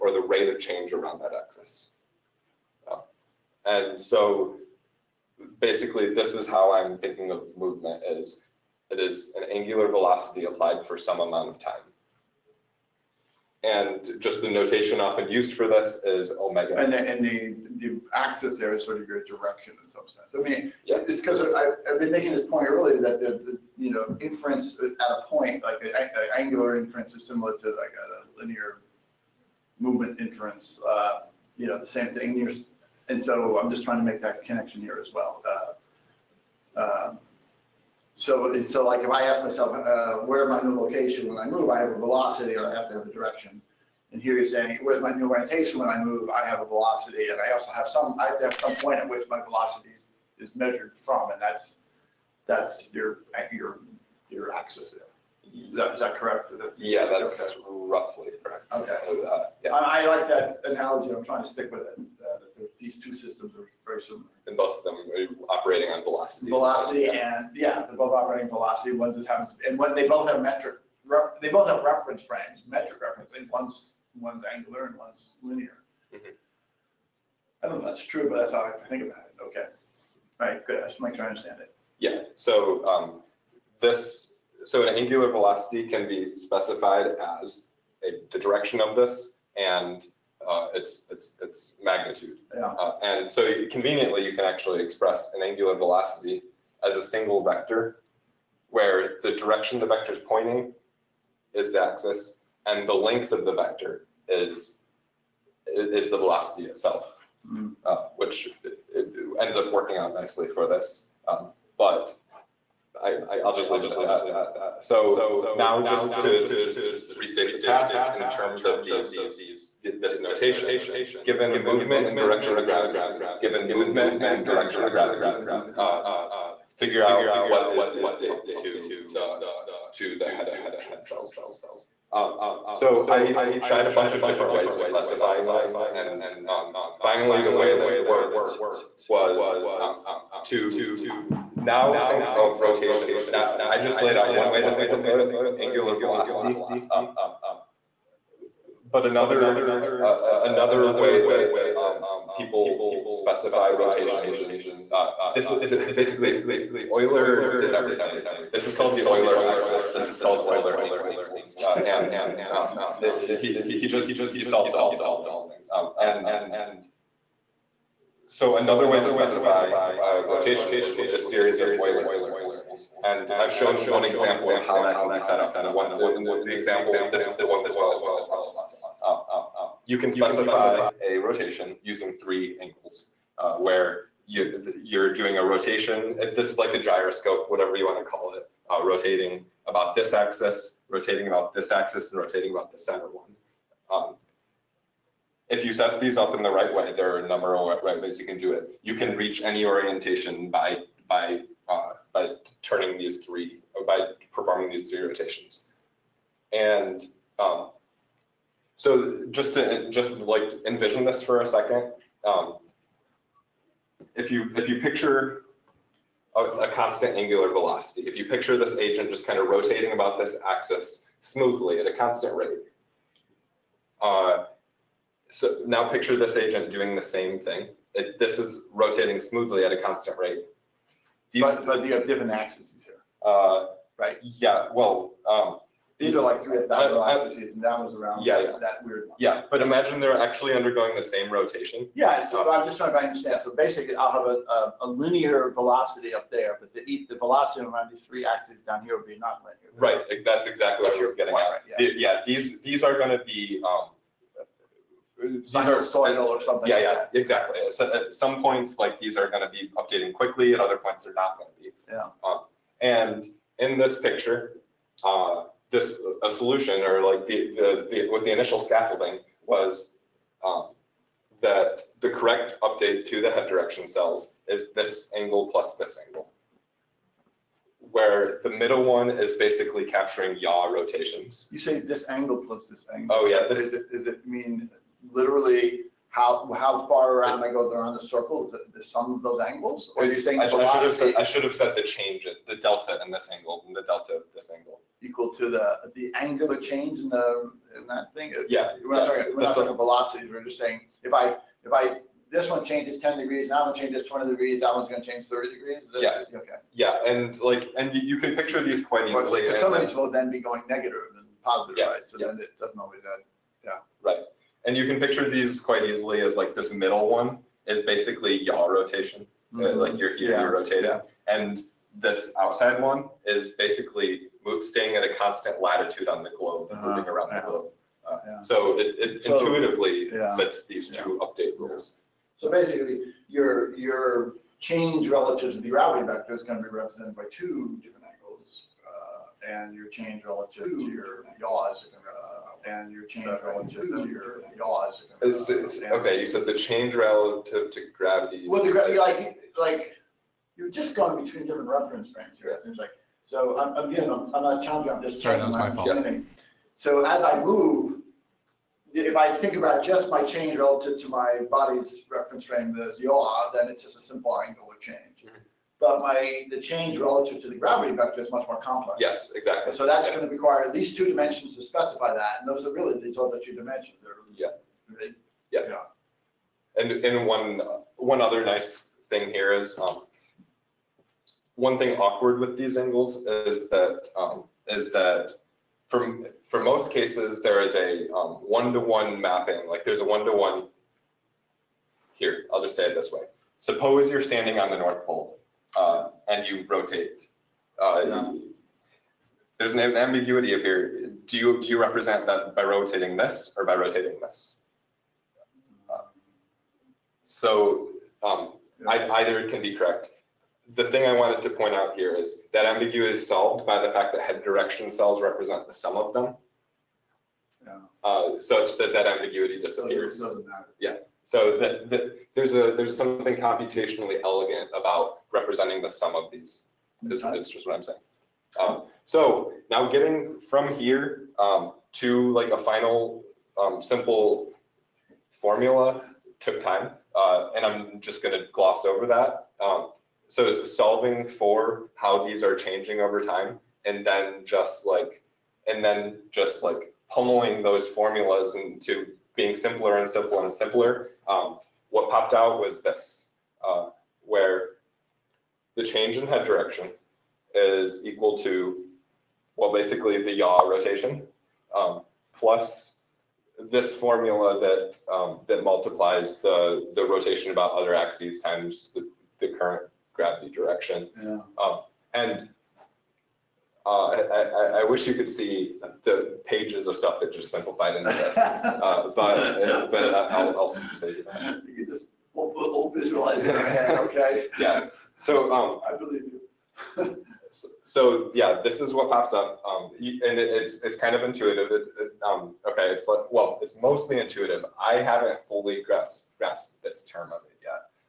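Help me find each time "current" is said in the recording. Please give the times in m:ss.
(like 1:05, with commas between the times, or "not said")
7:49.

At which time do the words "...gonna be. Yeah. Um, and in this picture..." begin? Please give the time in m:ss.
4:21.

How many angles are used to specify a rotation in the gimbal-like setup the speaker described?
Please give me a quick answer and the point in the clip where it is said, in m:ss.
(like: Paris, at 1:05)
3, at 3:02.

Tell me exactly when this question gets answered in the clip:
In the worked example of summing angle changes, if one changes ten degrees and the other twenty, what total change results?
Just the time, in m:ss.
5:05.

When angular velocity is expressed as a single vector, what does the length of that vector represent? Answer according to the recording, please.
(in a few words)
The velocity itself.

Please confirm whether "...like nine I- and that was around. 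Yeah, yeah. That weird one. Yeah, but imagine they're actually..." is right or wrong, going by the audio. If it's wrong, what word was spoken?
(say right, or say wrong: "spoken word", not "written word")
wrong: "three", not "nine".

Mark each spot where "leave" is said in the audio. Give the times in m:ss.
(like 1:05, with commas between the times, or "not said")
1:53.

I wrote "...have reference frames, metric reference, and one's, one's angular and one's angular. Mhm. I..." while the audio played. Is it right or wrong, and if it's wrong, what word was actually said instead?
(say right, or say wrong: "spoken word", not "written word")
wrong: "linear", not "angular".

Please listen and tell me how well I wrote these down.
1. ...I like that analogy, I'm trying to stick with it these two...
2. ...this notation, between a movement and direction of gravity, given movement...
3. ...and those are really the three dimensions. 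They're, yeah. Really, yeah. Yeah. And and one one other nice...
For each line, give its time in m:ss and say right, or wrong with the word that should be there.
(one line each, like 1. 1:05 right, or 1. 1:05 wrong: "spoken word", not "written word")
1. 0:59 right
2. 2:00 wrong: "given", not "between"
3. 6:12 wrong: "two", not "three".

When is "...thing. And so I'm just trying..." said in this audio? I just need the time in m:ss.
0:32.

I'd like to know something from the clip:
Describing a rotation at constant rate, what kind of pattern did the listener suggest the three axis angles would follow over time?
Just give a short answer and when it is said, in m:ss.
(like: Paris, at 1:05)
Sinusoidal, at 4:15.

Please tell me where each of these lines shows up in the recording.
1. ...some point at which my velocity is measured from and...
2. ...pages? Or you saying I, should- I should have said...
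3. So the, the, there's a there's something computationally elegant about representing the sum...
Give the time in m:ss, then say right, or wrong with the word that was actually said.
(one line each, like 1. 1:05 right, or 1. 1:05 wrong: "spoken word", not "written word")
1. 0:48 right
2. 4:49 wrong: "angles", not "pages"
3. 7:01 right.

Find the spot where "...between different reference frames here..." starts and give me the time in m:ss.
5:51.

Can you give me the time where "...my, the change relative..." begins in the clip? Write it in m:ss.
6:05.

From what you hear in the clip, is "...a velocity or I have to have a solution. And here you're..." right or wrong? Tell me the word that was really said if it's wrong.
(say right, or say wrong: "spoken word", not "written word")
wrong: "direction", not "solution".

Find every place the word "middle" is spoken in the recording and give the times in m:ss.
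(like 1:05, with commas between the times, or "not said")
4:38, 5:16.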